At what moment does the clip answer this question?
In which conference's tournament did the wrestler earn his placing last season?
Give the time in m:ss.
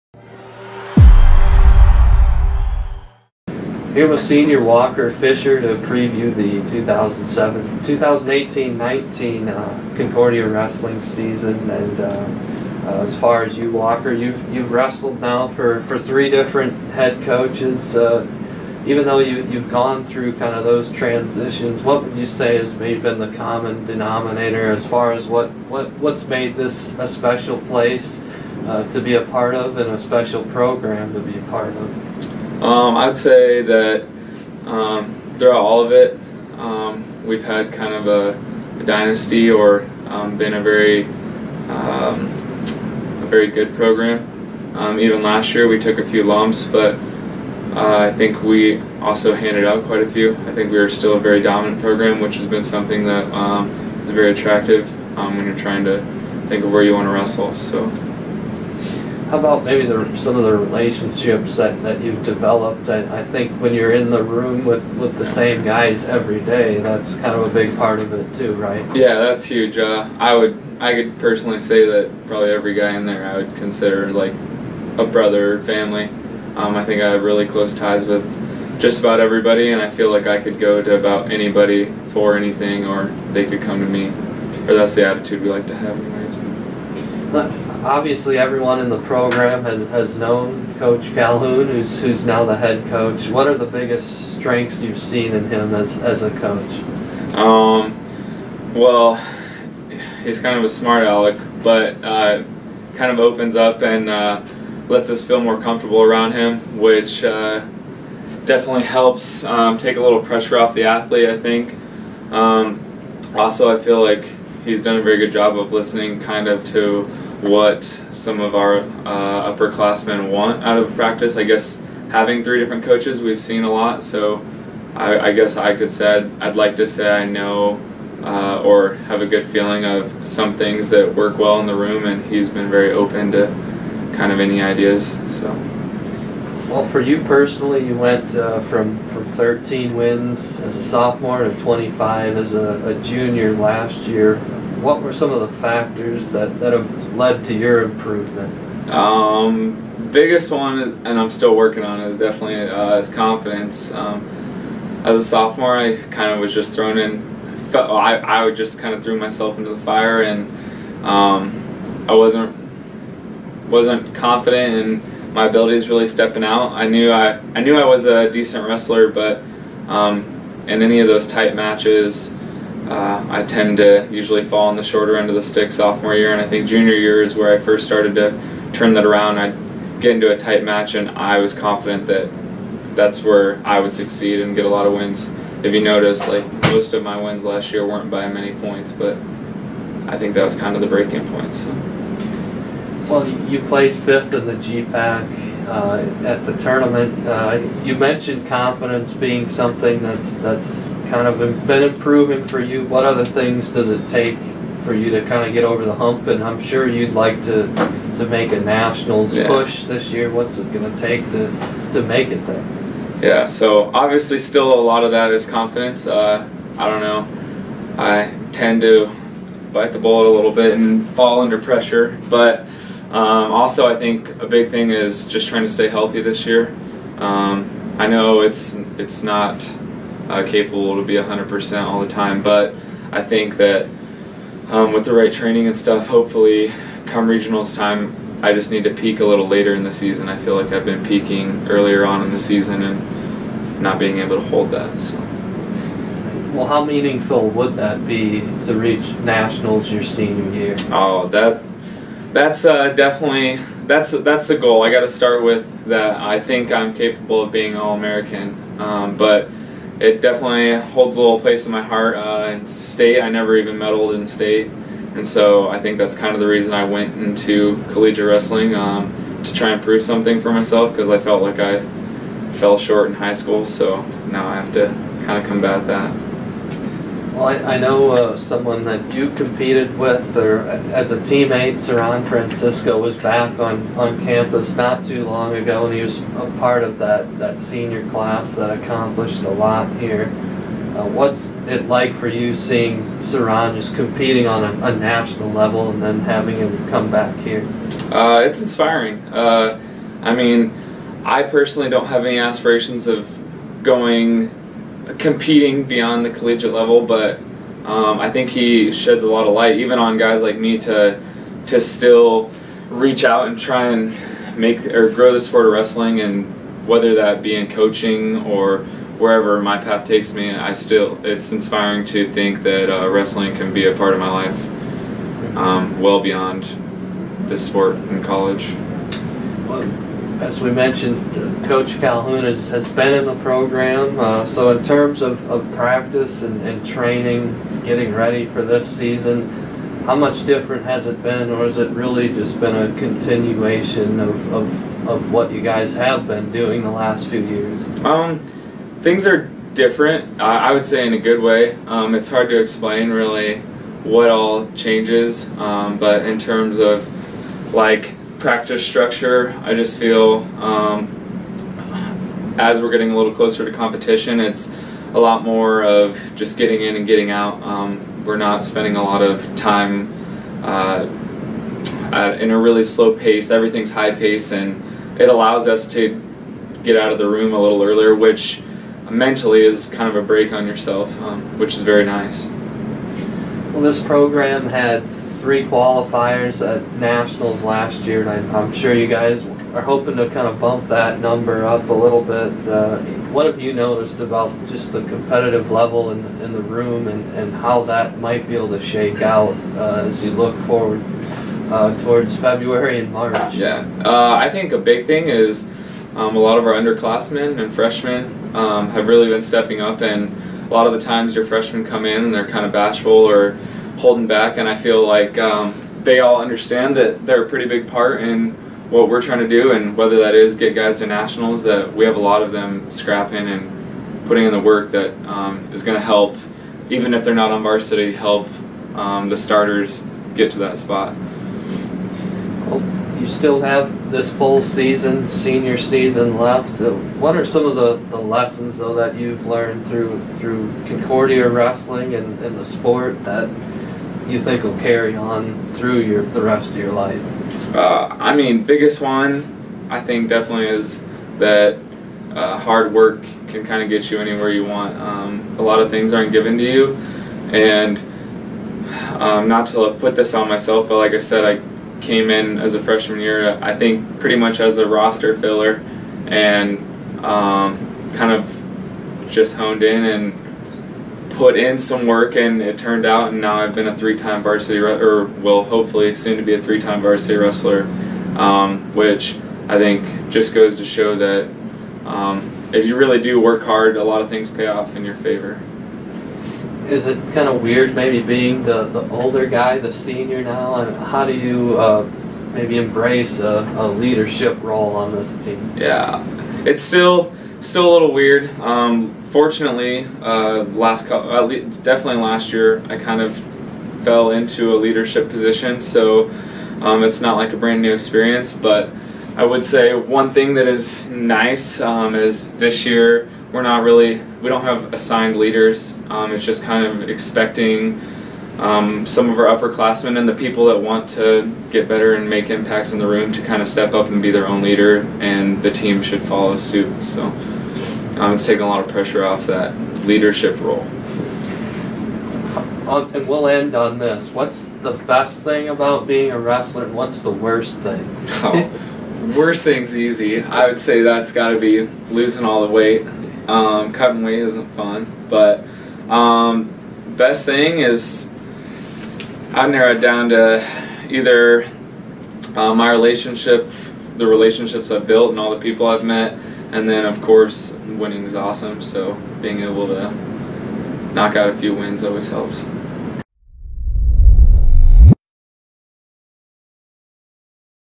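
3:14.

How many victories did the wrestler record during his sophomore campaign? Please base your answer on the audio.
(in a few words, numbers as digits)
13.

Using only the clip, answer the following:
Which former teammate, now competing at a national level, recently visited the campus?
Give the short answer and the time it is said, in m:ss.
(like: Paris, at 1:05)
Saran Francisco, at 4:41.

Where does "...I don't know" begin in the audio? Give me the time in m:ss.
3:36.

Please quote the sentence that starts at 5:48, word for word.
Um, things are different, I, I would say in a good way.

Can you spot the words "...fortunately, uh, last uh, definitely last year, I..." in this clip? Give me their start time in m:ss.
8:19.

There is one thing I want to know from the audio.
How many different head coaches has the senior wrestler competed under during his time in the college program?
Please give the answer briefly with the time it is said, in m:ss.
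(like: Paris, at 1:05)
3, at 0:15.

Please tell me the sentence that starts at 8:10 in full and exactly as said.
I mean, how do you uh, maybe embrace a, a leadership role on this team?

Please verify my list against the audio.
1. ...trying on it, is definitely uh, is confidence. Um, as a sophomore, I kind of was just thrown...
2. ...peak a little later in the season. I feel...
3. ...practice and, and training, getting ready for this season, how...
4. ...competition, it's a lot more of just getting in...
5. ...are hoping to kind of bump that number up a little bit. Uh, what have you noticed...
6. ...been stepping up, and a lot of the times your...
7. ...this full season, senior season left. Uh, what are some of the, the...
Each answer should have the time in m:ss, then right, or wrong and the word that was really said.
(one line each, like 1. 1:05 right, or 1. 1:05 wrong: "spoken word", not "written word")
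1. 2:31 wrong: "working", not "trying"
2. 3:58 right
3. 5:35 right
4. 6:03 right
5. 6:29 right
6. 6:49 right
7. 7:14 right.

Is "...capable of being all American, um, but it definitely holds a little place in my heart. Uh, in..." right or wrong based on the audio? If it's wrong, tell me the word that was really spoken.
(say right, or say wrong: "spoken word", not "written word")
right.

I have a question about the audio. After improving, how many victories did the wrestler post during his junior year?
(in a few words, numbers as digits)
25.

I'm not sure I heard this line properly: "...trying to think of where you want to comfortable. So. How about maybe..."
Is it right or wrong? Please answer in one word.
wrong.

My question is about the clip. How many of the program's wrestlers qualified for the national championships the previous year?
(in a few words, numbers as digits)
3.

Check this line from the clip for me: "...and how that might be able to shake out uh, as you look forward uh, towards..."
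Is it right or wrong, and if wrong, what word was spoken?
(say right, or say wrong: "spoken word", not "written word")
right.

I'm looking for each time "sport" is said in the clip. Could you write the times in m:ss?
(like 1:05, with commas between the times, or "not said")
5:15, 5:27, 7:22.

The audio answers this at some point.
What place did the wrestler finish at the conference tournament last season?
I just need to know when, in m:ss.
3:14.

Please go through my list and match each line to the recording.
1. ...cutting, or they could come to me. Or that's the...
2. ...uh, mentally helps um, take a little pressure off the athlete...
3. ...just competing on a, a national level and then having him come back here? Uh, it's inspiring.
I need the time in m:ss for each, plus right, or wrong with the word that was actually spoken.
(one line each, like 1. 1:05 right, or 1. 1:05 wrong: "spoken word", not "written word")
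1. 1:22 wrong: "anything", not "cutting"
2. 1:47 wrong: "definitely", not "mentally"
3. 4:53 right.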